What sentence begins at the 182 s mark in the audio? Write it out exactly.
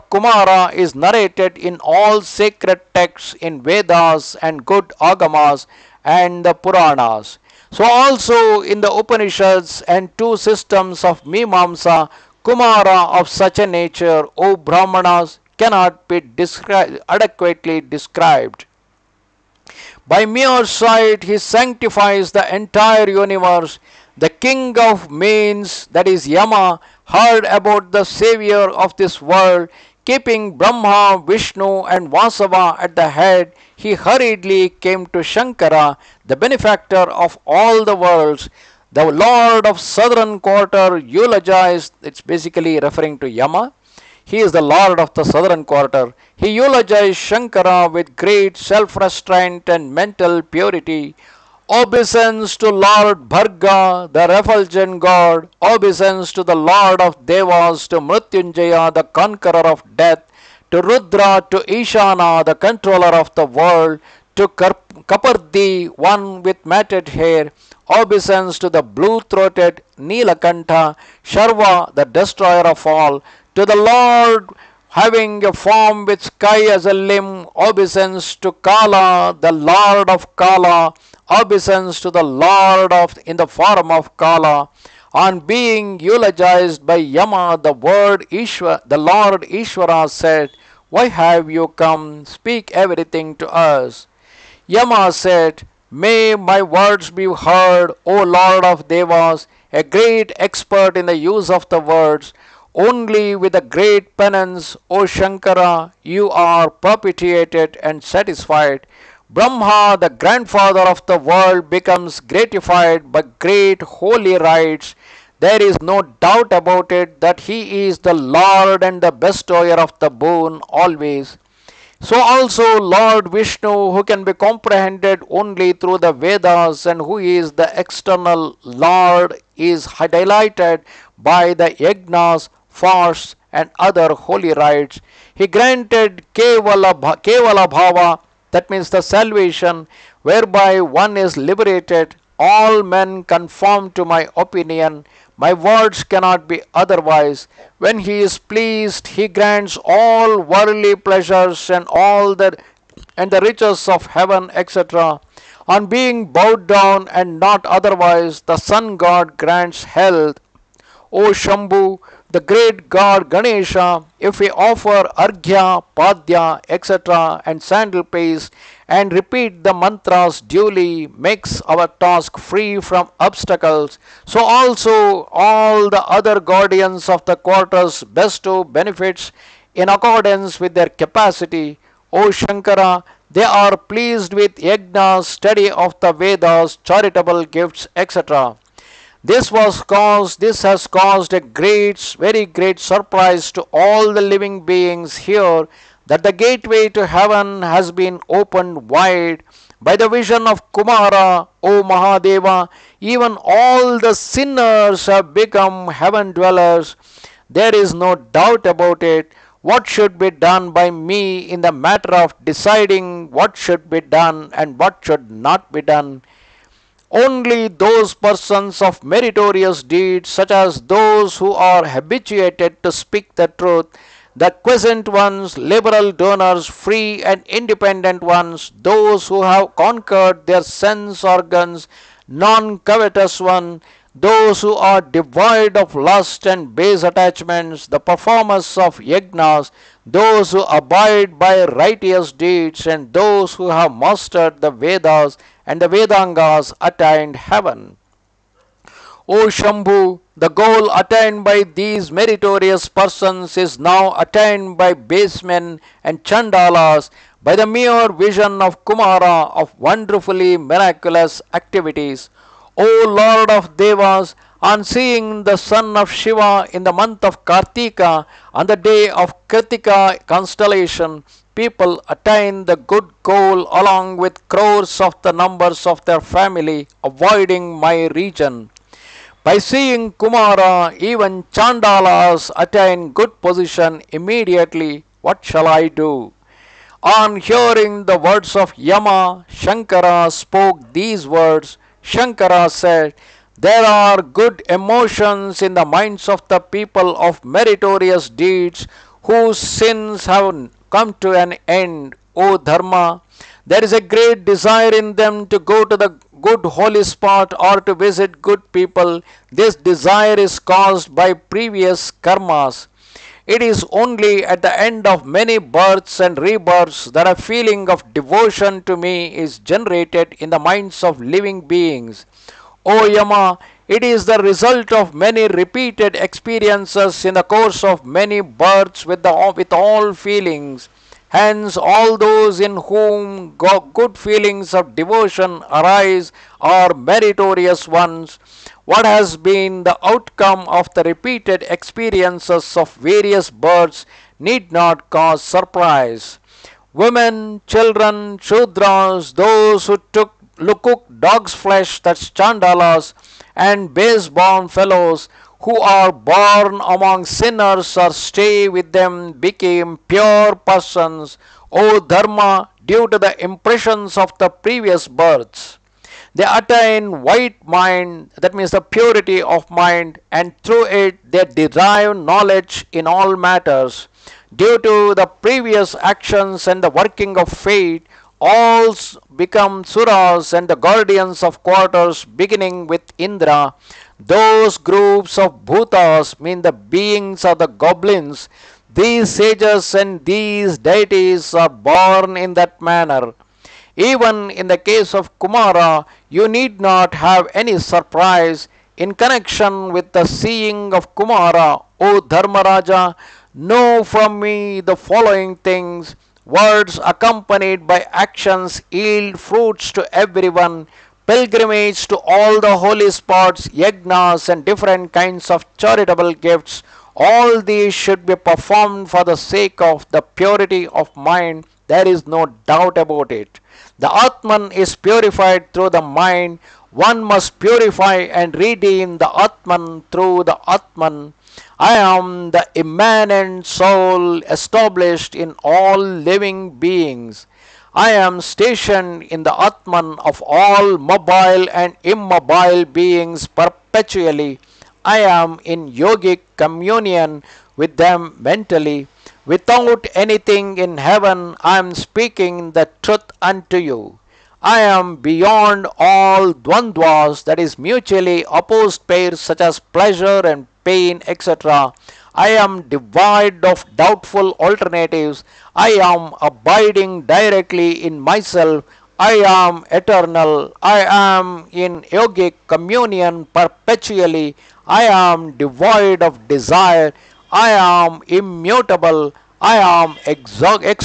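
O Shankara, they are pleased with yagnas, study of the Vedas, charitable gifts, etc.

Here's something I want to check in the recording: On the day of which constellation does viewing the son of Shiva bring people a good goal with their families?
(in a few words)
Kritika.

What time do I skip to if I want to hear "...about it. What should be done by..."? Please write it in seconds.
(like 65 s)
208 s.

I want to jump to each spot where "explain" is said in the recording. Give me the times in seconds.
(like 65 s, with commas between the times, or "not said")
not said.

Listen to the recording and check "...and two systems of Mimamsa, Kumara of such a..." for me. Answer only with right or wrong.
right.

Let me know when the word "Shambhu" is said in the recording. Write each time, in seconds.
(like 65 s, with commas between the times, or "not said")
161 s, 249 s.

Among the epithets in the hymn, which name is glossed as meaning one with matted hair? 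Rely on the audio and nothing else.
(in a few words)
Kapardi.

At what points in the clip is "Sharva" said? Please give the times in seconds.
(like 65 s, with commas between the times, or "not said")
71 s.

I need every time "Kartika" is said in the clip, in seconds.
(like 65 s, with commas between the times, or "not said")
267 s.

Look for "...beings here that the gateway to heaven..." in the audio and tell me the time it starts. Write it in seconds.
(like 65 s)
194 s.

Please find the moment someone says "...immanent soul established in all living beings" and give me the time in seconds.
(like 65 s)
432 s.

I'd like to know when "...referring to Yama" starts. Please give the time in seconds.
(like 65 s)
42 s.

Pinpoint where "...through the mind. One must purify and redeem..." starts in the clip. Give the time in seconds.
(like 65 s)
425 s.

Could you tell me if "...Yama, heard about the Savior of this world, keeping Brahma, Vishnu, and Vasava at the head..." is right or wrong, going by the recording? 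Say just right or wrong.
right.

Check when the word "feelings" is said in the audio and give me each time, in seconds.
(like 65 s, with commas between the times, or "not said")
317 s, 330 s, 334 s.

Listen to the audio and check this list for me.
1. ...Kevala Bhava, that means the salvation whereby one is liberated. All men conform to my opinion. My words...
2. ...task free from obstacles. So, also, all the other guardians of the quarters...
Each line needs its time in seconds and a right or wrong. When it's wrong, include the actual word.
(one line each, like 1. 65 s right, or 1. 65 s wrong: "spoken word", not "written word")
1. 137 s right
2. 171 s right.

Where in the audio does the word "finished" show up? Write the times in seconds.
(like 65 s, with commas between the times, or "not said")
not said.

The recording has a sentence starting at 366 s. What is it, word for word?
They attain white mind, that means the purity of mind, and through it they derive knowledge in all matters.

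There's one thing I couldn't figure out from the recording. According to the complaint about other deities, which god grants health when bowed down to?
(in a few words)
the sun god.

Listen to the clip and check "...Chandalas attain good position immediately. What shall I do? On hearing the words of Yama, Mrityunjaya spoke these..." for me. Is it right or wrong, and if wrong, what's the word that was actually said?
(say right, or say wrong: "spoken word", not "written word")
wrong: "Shankara", not "Mrityunjaya".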